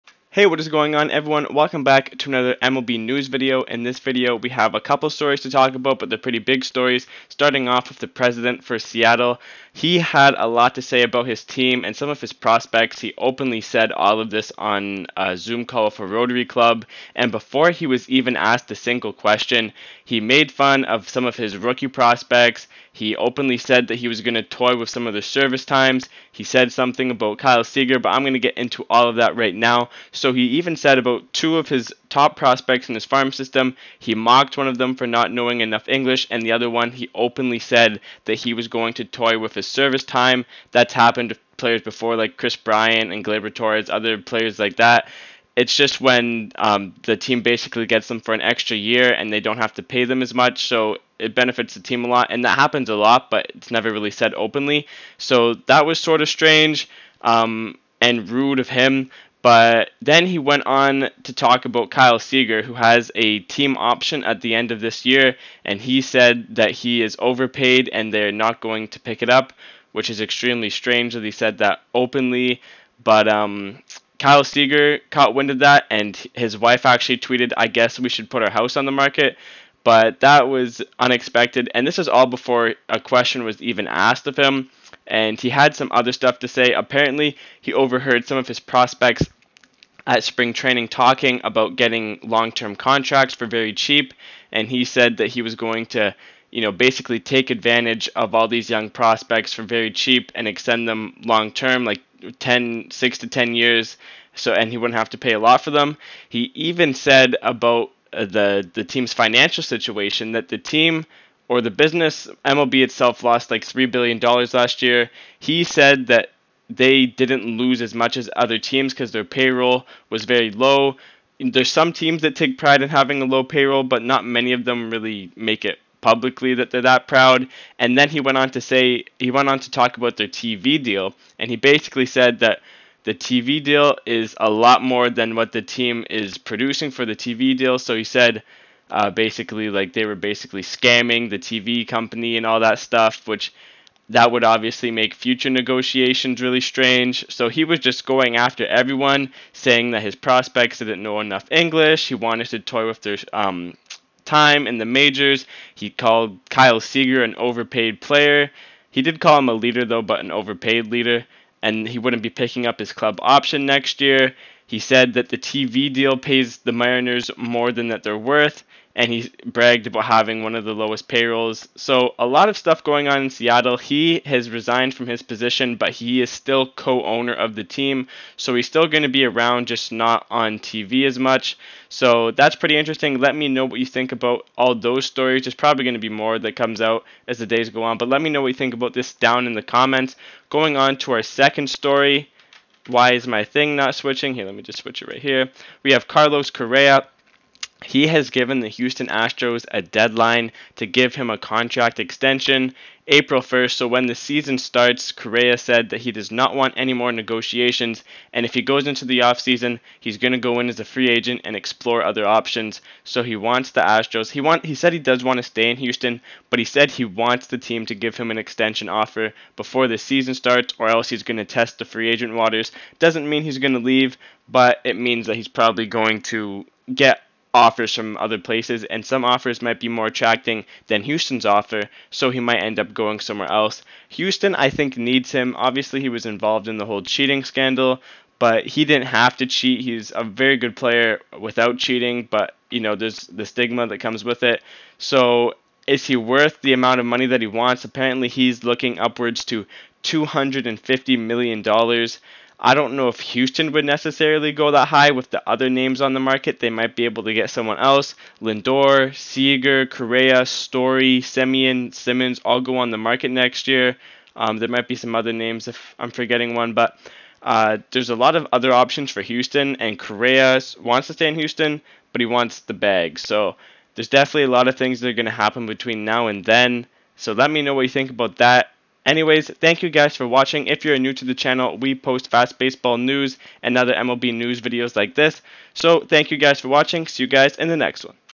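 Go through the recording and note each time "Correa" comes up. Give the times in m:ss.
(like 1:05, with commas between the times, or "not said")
3:16, 3:25, 4:19, 4:29.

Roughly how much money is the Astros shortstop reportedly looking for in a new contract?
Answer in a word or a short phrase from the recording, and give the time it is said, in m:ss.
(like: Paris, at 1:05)
250 million dollars, at 4:10.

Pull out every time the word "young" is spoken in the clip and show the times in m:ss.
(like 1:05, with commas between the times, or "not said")
1:38.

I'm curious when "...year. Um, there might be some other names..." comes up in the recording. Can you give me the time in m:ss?
4:23.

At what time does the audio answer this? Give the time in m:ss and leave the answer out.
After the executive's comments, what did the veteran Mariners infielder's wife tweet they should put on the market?
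1:18.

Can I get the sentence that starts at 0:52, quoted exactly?
And that happens a lot, but it's never really said openly.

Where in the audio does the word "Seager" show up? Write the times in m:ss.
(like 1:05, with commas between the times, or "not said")
0:27, 1:02, 1:14, 2:36, 4:19.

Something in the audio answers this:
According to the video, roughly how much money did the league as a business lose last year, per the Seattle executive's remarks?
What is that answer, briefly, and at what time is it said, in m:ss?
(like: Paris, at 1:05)
3 billion dollars, at 1:53.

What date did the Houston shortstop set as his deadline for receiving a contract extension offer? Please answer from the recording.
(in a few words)
April 1st.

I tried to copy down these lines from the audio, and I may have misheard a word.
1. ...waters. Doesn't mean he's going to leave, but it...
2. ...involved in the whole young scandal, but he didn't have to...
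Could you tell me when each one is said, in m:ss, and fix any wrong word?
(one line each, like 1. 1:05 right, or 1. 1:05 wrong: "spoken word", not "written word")
1. 3:42 right
2. 3:56 wrong: "cheating", not "young".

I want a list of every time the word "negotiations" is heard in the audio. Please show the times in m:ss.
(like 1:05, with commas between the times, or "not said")
2:25, 3:27.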